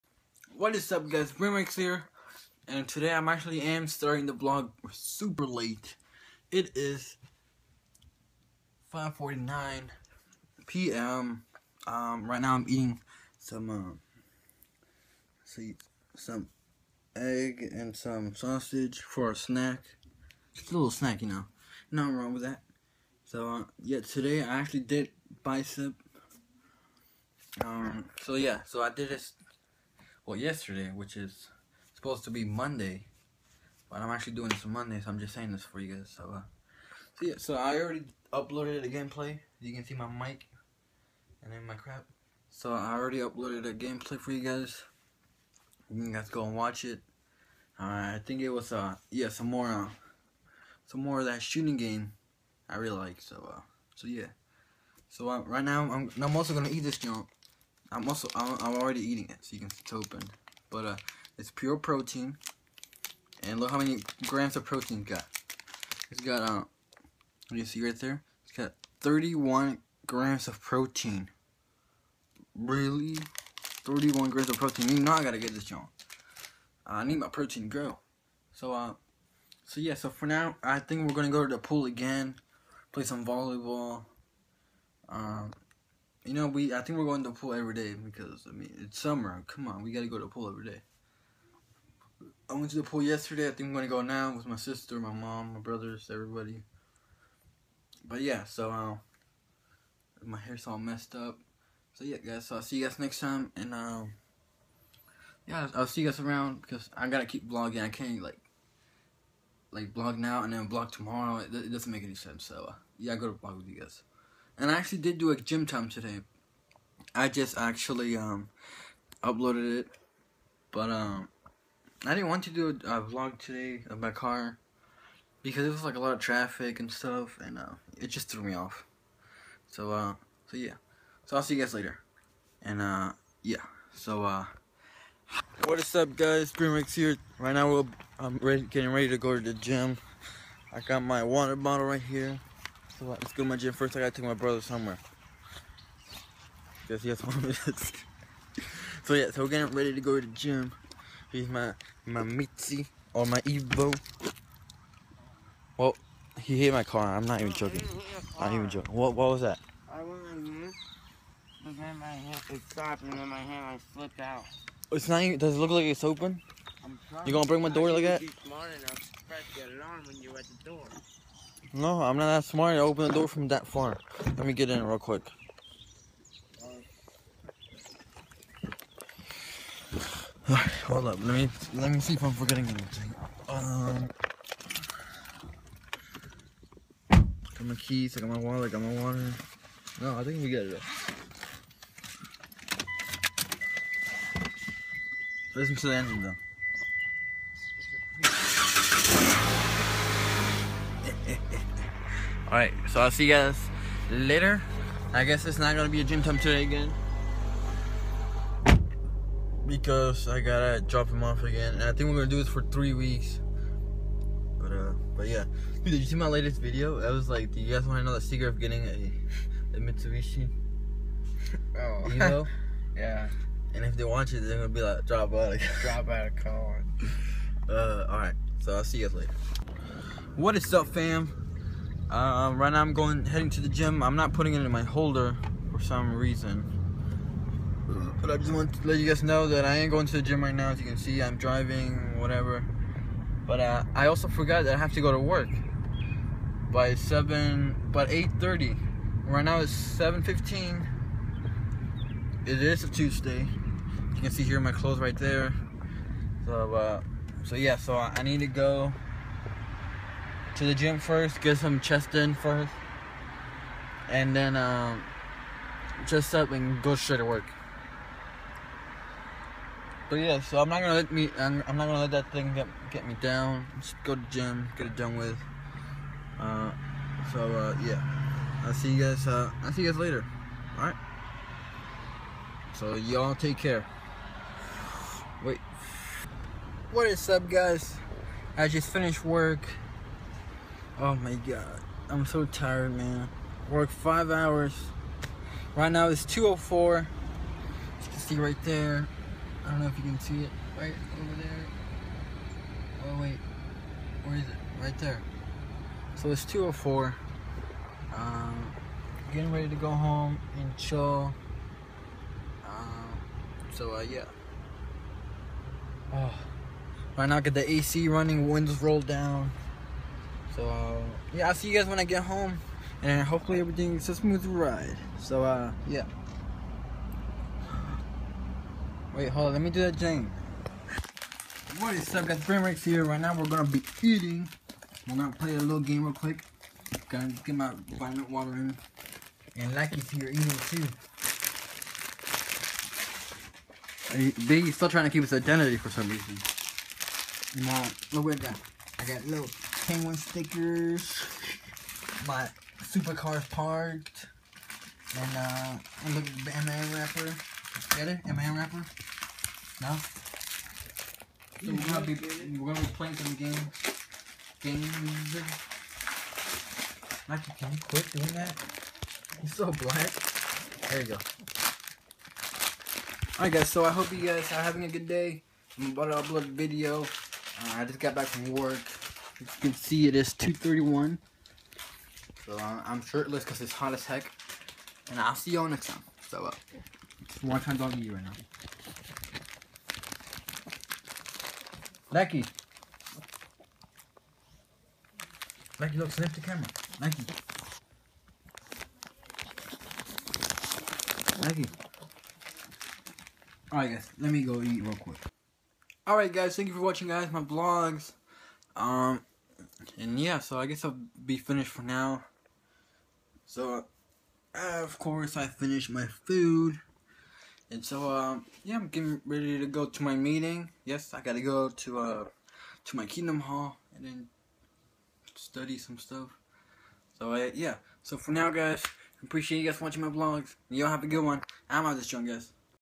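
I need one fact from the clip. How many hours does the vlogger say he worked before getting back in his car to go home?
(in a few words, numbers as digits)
5.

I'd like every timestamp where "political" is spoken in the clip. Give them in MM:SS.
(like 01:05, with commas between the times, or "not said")
not said.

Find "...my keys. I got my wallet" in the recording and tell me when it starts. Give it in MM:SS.
03:07.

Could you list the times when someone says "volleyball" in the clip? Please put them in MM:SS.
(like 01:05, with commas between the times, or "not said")
01:23.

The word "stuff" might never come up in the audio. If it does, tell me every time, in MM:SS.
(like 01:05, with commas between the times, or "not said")
02:06, 07:05.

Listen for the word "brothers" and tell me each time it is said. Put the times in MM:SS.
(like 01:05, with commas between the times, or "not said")
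01:35, 02:24.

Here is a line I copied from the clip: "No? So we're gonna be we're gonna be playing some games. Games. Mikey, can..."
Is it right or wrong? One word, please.
right.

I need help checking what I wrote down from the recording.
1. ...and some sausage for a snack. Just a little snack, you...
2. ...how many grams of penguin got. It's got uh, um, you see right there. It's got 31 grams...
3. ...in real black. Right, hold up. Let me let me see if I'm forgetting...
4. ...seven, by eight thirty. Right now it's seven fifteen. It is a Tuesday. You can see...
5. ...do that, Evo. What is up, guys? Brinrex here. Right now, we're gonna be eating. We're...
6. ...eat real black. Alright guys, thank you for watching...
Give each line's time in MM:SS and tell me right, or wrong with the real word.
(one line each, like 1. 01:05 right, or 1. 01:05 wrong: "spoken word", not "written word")
1. 00:17 right
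2. 01:03 wrong: "protein", not "penguin"
3. 02:54 wrong: "quick", not "black"
4. 04:06 right
5. 05:29 wrong: "Jane", not "Evo"
6. 06:44 wrong: "quick", not "black".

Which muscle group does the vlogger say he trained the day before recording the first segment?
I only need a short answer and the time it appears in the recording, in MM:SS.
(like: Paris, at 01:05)
Bicep, at 00:25.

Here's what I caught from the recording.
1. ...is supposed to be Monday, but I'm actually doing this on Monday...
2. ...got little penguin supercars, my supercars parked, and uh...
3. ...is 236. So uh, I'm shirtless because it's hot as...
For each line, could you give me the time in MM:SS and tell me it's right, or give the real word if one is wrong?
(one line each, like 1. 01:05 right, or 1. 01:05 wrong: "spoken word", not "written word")
1. 00:31 right
2. 05:49 wrong: "stickers", not "supercars"
3. 06:20 wrong: "231", not "236".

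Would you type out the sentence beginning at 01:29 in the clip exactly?
Come on, we gotta go to the pool every day.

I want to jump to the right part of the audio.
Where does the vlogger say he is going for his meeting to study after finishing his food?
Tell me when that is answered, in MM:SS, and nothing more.
07:03.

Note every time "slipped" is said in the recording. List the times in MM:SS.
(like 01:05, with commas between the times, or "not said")
02:43.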